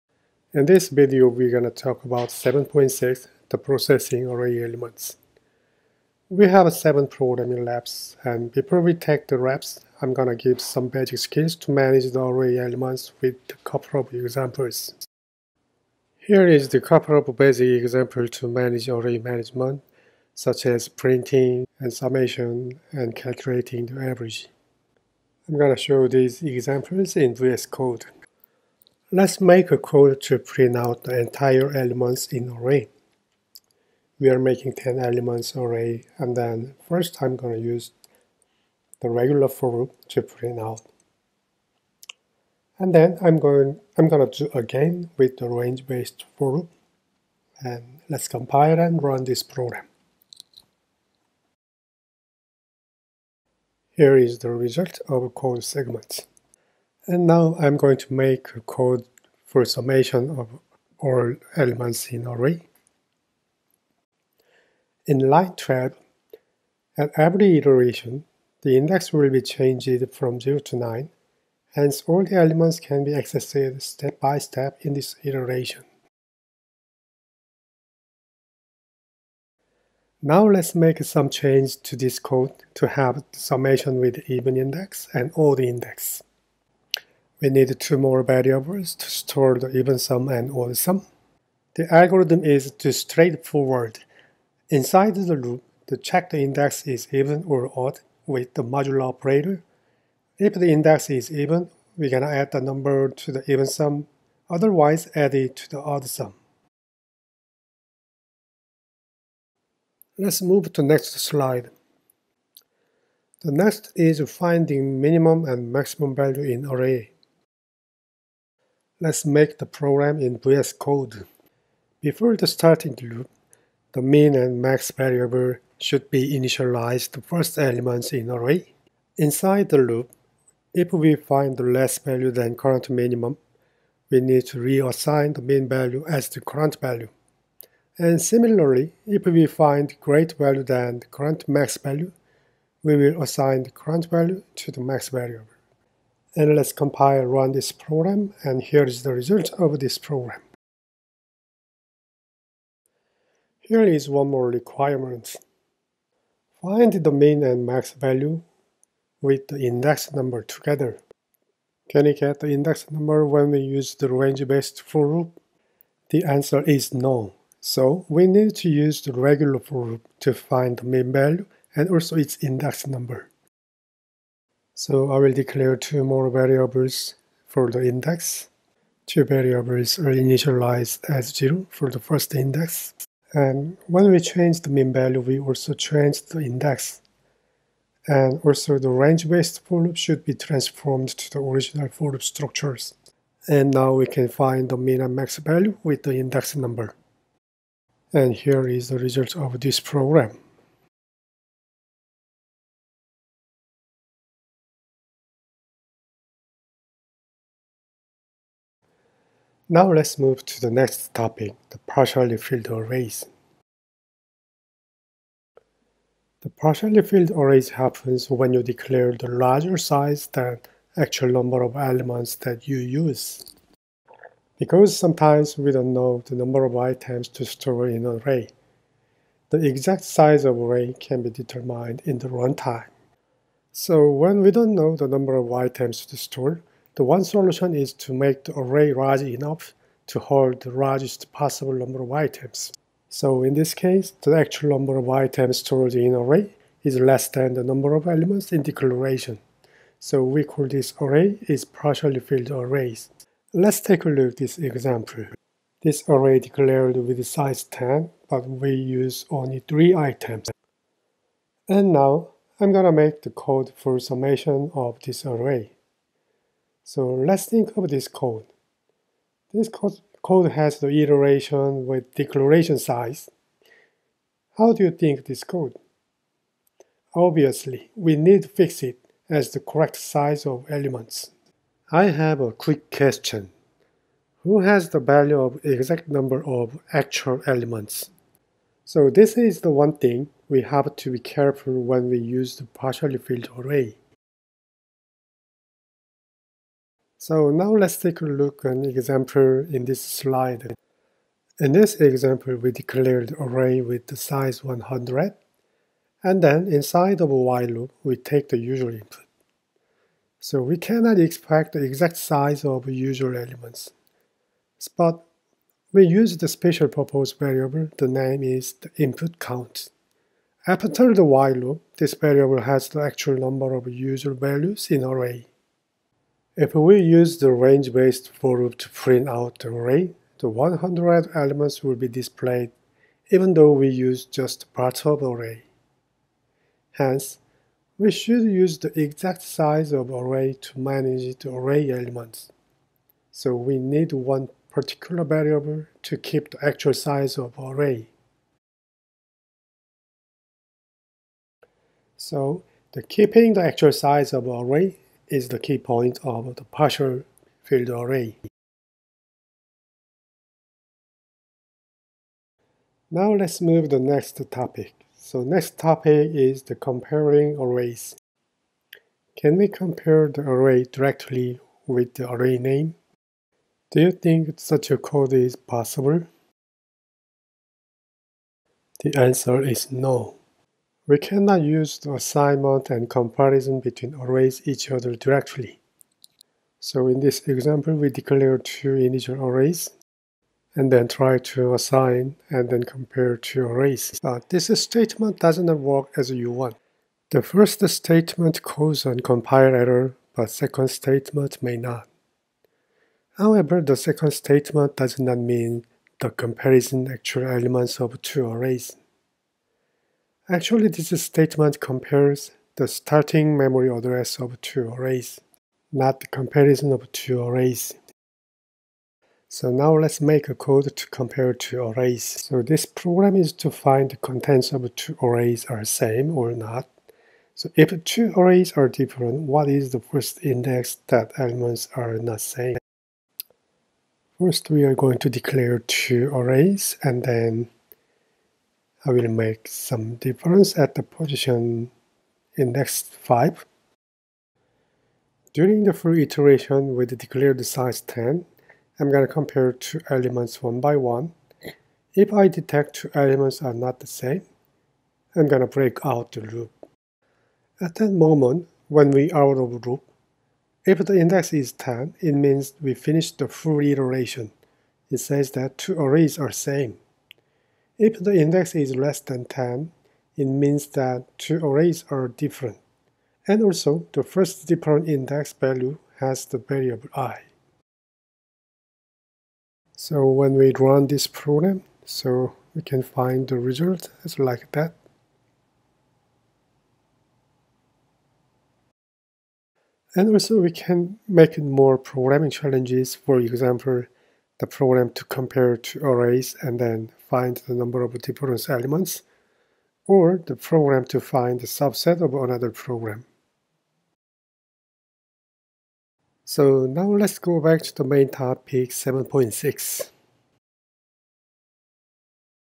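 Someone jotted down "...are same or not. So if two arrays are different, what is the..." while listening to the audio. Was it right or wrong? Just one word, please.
right.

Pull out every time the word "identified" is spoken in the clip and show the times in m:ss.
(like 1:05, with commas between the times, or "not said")
not said.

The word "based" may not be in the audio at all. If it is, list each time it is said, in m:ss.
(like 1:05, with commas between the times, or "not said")
0:45, 2:44, 3:08, 5:27.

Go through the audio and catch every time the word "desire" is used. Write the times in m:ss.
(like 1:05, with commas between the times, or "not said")
not said.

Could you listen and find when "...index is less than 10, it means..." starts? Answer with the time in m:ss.
7:48.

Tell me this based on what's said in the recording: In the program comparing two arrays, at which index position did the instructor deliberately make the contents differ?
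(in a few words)
5.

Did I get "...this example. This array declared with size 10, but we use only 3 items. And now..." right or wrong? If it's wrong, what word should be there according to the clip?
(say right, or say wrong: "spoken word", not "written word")
right.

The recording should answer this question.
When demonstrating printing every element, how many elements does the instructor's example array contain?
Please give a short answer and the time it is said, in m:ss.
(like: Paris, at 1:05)
10, at 0:34.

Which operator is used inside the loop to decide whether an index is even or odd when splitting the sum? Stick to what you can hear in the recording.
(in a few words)
modular operator.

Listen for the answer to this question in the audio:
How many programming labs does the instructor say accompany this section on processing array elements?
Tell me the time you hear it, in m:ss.
0:06.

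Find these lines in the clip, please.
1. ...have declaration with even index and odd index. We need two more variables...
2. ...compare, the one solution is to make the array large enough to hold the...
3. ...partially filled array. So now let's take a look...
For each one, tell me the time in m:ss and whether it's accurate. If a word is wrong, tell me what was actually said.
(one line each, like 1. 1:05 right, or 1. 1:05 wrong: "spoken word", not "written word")
1. 1:22 wrong: "summation", not "declaration"
2. 3:56 wrong: "store", not "compare"
3. 4:52 right.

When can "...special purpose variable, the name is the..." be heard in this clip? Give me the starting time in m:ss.
5:16.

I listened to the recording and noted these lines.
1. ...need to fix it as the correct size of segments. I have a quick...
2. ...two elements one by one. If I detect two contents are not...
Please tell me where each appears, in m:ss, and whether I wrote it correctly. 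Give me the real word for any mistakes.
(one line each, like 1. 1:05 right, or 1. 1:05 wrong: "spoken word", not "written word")
1. 4:38 wrong: "elements", not "segments"
2. 7:29 wrong: "elements", not "contents".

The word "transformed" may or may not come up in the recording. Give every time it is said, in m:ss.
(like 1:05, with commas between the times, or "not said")
3:10.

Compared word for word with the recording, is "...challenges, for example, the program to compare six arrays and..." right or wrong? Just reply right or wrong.
wrong.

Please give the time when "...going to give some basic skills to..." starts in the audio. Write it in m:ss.
0:10.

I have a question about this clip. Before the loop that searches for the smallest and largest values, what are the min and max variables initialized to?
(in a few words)
first elements in array.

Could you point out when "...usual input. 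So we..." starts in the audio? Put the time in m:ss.
5:08.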